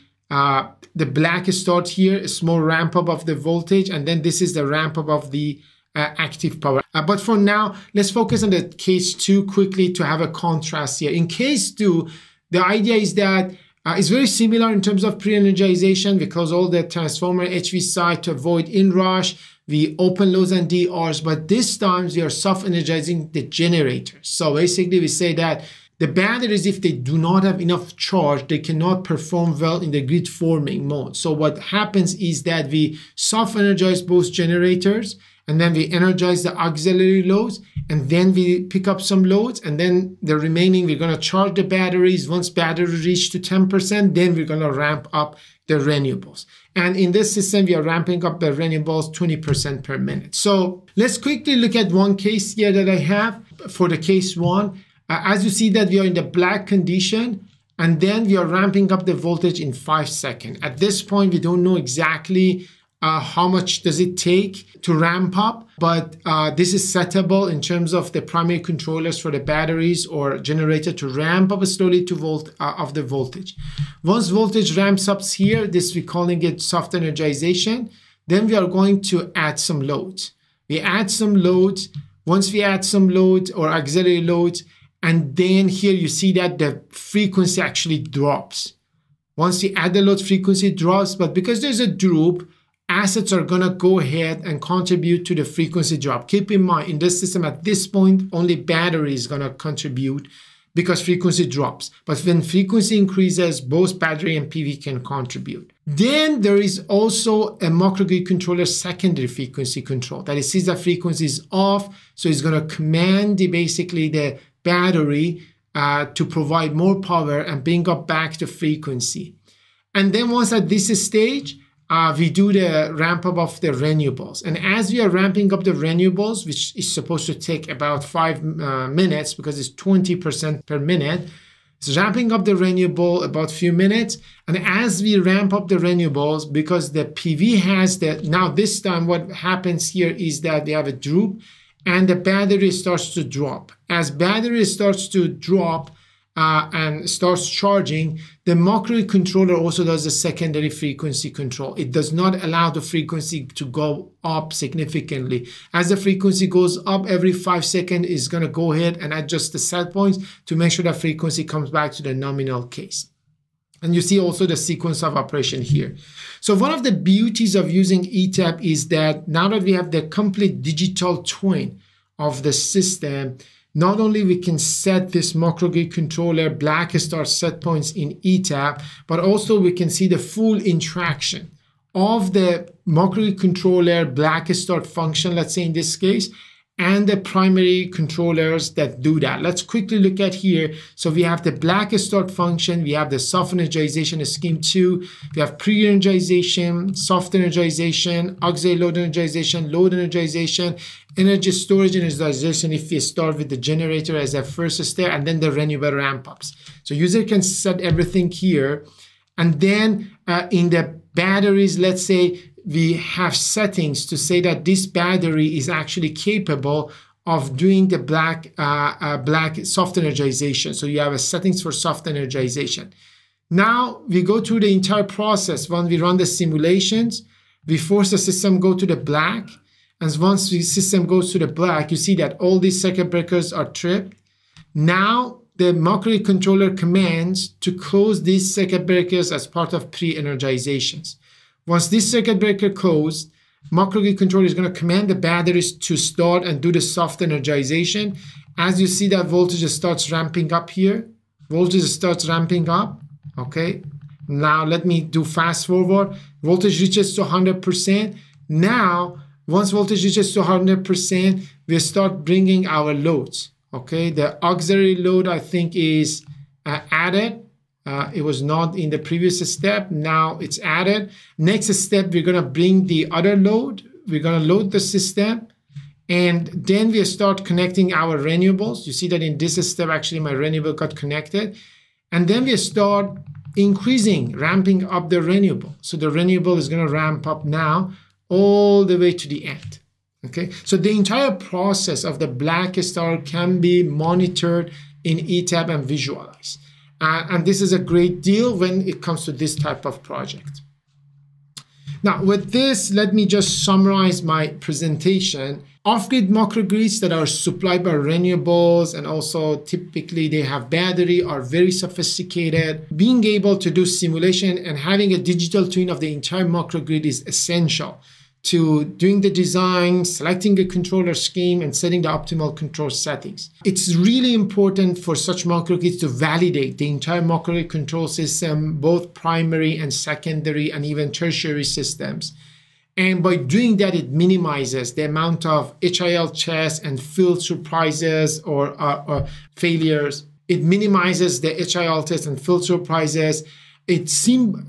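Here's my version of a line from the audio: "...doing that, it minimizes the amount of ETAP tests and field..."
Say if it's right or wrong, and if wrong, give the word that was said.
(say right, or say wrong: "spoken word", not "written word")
wrong: "HIL", not "ETAP".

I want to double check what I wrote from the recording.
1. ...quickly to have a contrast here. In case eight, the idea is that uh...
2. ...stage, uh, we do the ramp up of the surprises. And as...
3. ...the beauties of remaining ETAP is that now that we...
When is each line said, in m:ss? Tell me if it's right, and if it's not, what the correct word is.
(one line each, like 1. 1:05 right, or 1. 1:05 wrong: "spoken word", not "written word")
1. 0:09 wrong: "two", not "eight"
2. 2:01 wrong: "renewables", not "surprises"
3. 2:46 wrong: "using", not "remaining".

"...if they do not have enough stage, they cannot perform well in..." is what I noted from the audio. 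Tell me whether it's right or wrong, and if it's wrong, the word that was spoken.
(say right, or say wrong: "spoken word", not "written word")
wrong: "charge", not "stage".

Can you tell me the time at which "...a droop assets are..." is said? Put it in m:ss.
1:31.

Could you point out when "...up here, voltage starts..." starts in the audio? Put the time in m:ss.
4:10.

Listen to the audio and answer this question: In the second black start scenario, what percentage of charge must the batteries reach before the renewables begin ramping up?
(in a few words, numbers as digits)
10%.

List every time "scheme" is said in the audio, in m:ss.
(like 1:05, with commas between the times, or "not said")
3:14, 5:21.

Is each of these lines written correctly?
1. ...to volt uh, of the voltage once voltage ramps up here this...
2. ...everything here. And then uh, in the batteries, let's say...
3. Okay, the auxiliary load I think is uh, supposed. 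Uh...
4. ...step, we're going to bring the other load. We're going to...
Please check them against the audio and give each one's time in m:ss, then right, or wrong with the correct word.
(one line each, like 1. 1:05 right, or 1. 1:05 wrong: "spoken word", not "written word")
1. 1:12 right
2. 3:27 right
3. 4:23 wrong: "added", not "supposed"
4. 4:31 right.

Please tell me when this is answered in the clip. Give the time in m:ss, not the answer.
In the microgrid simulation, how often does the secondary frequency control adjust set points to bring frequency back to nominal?
2:37.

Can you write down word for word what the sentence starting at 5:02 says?
Now, with this, let me just summarize my presentation.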